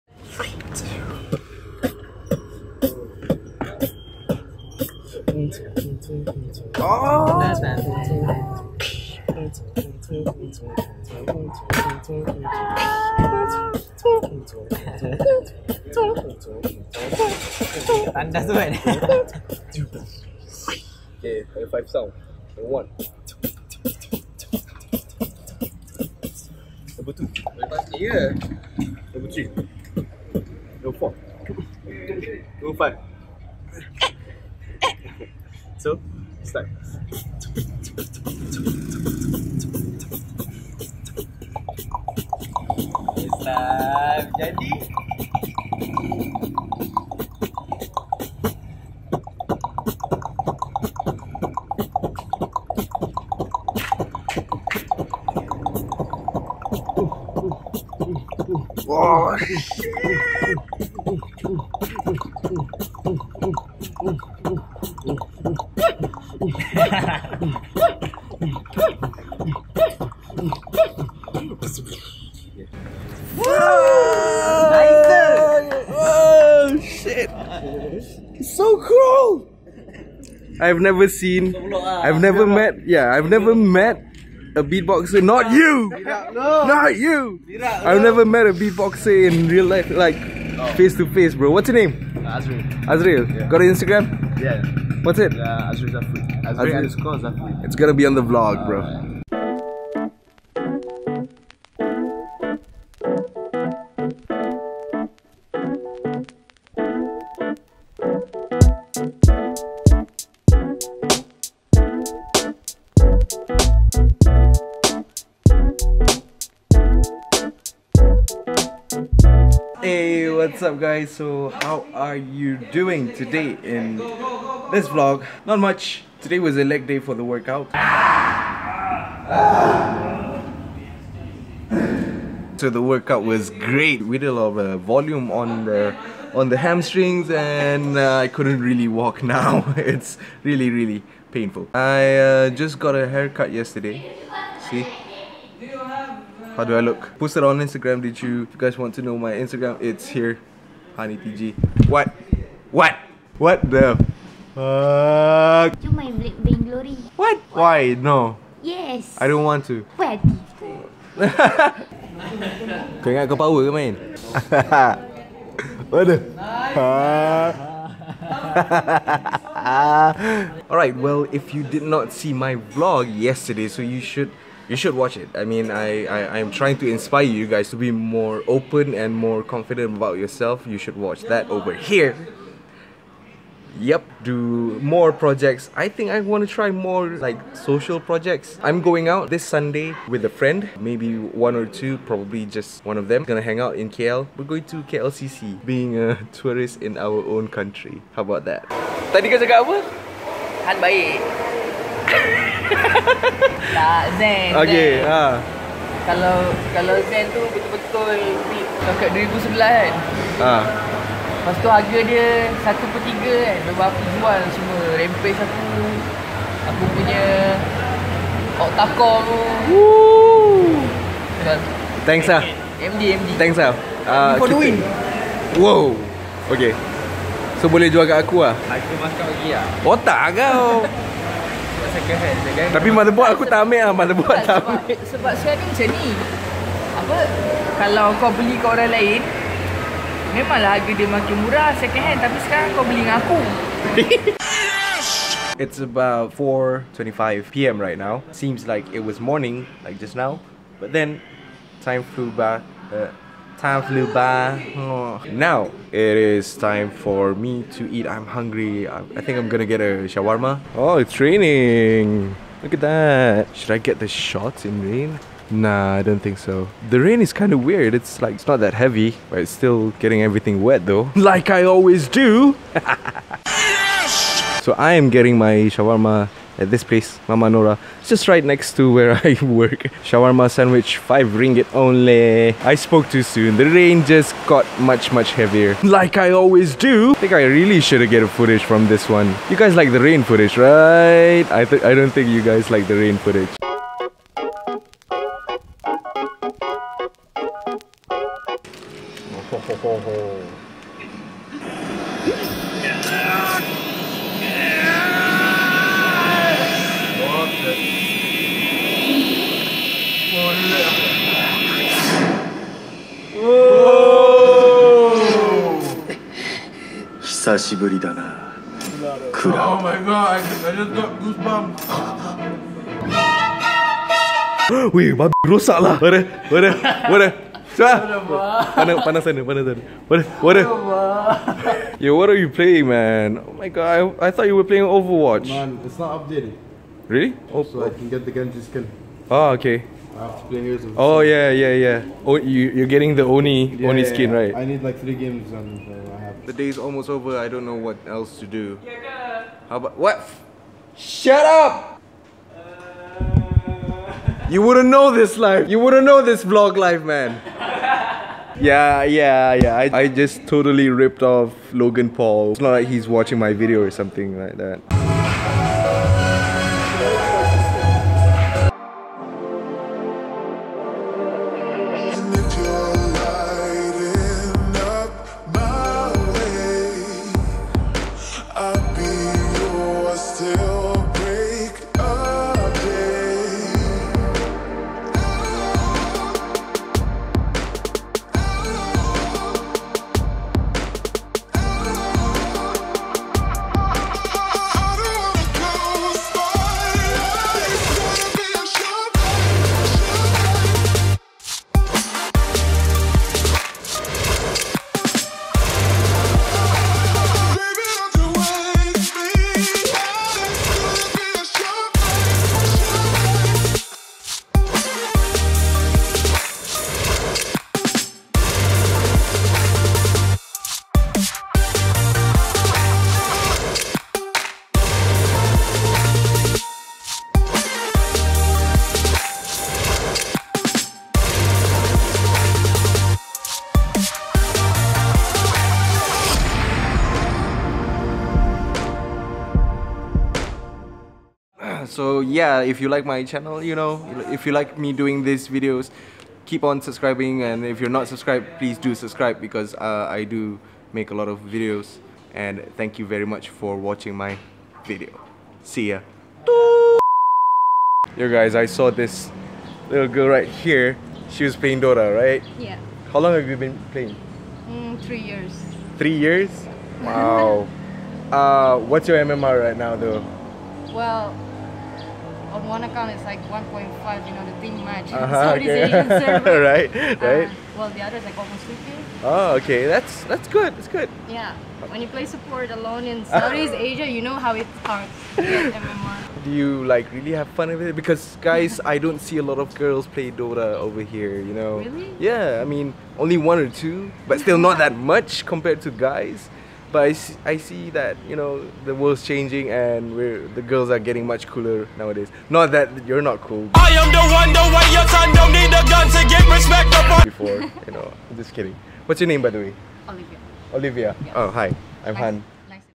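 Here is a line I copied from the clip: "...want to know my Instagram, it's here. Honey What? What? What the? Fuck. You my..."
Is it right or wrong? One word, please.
right.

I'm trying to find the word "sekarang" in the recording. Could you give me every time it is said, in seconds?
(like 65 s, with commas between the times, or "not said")
235 s, 242 s.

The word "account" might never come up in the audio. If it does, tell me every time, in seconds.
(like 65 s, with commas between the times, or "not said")
472 s.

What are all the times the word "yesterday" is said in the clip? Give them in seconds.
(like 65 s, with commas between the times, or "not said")
143 s, 173 s.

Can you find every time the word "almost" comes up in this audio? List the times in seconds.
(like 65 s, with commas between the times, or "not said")
346 s, 478 s.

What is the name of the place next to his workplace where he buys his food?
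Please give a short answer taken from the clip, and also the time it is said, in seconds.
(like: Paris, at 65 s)
Mama Nora, at 277 s.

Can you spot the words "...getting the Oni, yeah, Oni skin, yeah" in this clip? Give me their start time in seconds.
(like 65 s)
342 s.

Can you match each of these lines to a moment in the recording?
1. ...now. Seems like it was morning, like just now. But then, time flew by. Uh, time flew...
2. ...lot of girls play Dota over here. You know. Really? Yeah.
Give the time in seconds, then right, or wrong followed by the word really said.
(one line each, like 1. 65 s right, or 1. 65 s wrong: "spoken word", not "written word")
1. 247 s right
2. 489 s right.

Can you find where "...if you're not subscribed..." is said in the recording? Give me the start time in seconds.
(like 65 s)
447 s.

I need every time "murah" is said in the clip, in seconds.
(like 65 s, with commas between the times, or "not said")
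241 s.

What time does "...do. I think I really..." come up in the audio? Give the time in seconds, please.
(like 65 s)
286 s.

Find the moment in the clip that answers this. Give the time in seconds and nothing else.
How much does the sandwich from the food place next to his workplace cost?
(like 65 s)
280 s.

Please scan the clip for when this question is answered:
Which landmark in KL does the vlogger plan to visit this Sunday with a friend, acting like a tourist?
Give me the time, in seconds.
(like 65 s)
194 s.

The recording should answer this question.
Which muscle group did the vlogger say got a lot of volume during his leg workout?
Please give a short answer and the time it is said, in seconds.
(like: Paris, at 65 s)
Hamstrings, at 136 s.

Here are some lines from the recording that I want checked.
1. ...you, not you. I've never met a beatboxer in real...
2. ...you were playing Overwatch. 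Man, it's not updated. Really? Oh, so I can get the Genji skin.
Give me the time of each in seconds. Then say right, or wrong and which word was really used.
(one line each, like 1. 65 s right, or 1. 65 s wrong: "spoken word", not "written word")
1. 85 s right
2. 334 s right.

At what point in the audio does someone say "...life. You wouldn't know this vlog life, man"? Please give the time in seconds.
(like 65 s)
355 s.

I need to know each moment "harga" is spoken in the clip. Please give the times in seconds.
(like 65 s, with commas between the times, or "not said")
211 s, 240 s.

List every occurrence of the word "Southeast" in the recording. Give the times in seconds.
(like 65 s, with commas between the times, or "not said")
483 s.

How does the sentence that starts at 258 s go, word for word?
I, I think I'm gonna get a shawarma.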